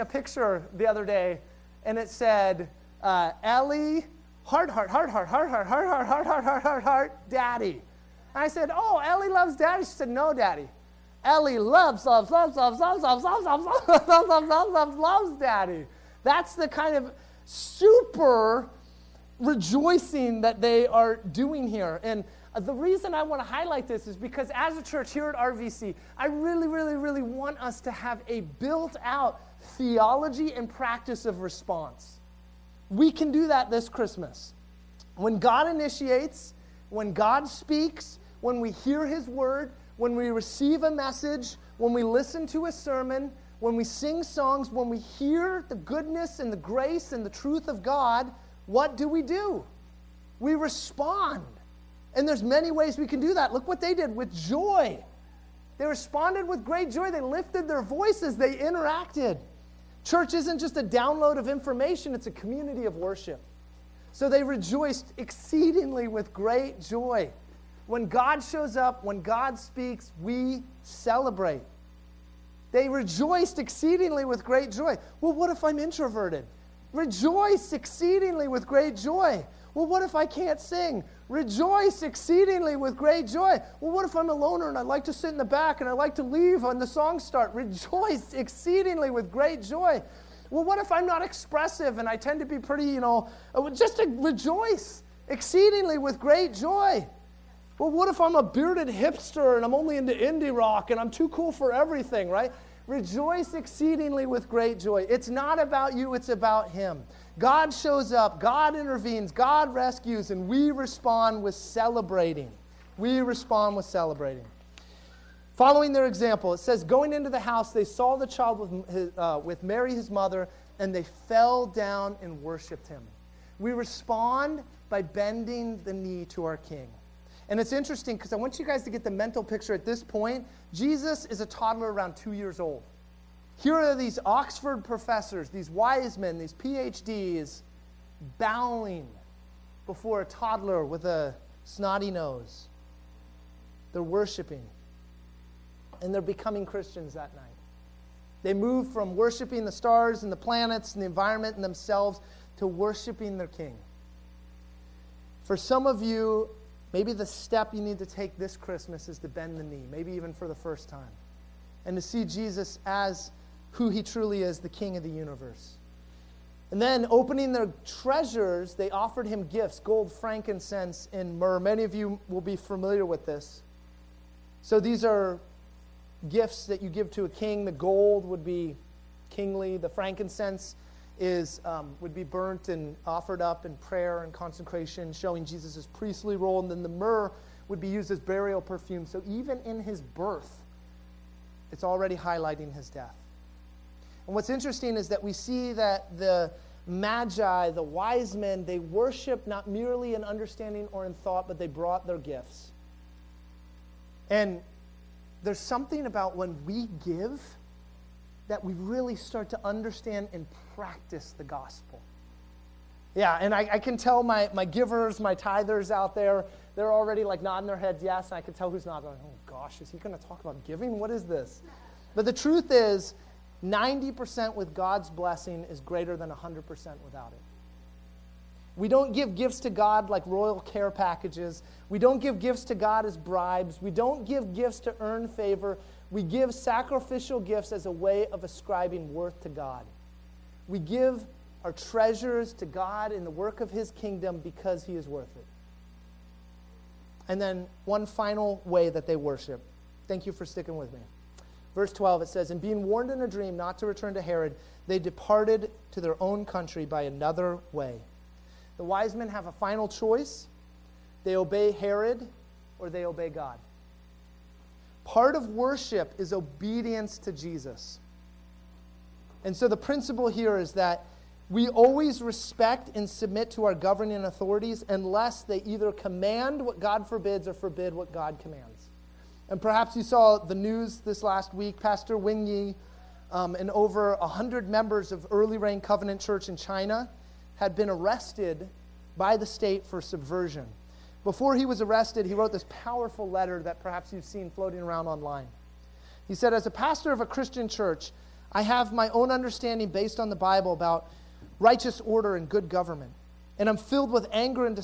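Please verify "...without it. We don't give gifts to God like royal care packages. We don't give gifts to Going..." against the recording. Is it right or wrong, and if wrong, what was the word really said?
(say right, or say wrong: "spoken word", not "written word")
wrong: "God", not "Going".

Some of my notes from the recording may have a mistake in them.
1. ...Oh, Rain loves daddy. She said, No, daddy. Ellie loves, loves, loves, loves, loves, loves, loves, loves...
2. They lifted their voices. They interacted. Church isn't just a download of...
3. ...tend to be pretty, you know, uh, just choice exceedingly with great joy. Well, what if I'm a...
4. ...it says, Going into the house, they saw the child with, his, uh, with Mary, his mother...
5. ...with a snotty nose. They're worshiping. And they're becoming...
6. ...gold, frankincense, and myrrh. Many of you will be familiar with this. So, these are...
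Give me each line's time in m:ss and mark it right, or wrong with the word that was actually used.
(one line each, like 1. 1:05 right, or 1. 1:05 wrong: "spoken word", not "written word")
1. 0:08 wrong: "Ellie", not "Rain"
2. 0:57 right
3. 1:32 wrong: "rejoice", not "choice"
4. 1:56 right
5. 2:20 right
6. 2:49 right.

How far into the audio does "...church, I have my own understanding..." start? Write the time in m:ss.
4:57.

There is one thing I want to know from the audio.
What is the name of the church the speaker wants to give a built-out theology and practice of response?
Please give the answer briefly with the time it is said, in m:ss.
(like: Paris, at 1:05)
RVC, at 0:25.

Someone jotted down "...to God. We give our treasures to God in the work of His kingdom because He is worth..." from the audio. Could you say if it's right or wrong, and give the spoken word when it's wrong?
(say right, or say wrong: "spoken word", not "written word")
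right.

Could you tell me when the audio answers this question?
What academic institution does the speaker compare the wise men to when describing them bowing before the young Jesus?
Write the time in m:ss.
2:14.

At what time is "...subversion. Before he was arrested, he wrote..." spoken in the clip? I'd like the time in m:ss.
4:50.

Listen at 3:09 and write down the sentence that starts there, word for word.
So even in his birth, it's already highlighting his death.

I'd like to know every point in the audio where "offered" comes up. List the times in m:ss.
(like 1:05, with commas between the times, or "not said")
2:48, 3:03.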